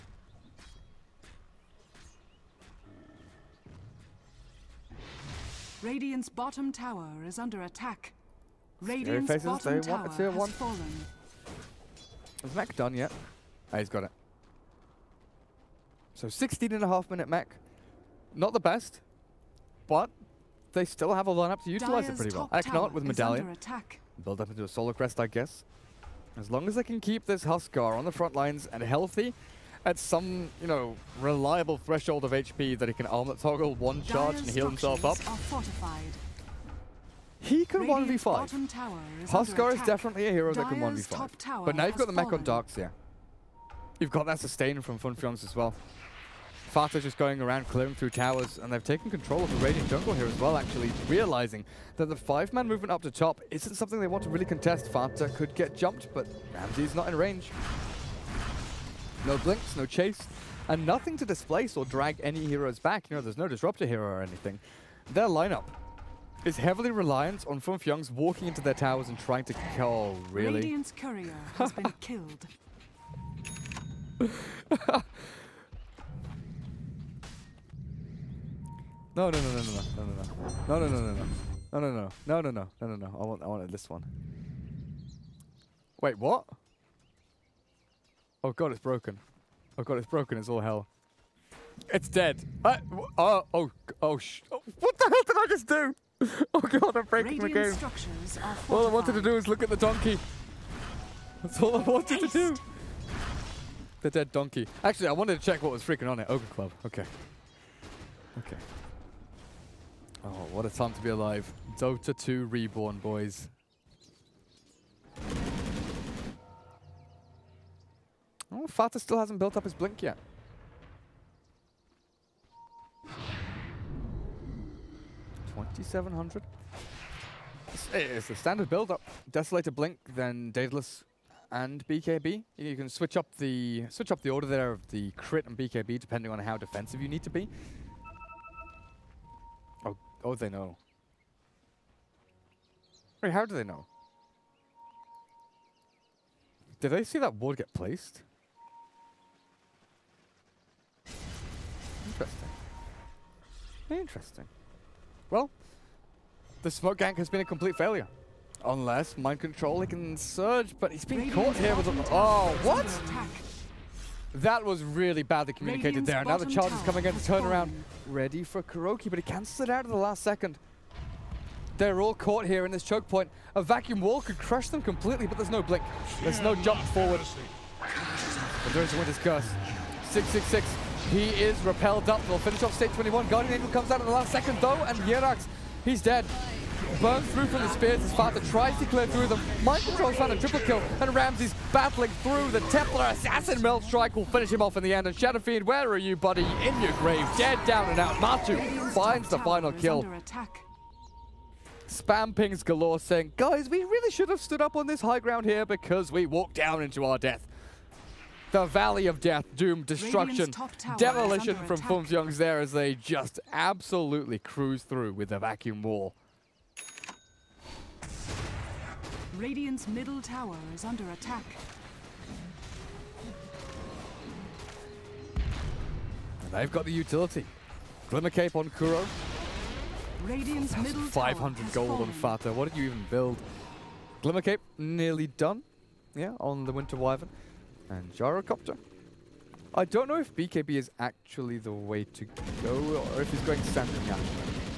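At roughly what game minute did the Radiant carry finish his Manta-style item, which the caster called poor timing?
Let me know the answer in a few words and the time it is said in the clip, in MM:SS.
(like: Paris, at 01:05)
16 and a half, at 00:16.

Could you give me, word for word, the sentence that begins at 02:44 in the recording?
That was really badly communicated Radiant's there.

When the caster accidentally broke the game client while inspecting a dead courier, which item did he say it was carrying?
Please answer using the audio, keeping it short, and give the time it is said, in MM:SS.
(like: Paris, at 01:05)
Ogre Club, at 01:46.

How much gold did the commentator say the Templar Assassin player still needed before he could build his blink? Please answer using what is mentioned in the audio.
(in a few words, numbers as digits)
2700.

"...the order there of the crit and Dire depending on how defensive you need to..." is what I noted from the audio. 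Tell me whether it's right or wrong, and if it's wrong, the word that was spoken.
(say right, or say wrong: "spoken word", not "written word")
wrong: "BKB", not "Dire".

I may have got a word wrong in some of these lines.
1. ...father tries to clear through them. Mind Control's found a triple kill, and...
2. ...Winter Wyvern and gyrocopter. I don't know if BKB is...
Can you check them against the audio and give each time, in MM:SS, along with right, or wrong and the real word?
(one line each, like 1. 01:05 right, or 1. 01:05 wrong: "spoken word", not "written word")
1. 03:08 right
2. 03:56 right.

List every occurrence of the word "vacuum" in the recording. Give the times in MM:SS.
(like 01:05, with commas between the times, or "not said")
02:53, 03:35.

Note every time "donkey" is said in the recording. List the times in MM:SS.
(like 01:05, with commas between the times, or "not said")
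01:39, 01:44.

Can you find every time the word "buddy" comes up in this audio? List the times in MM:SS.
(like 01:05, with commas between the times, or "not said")
03:16.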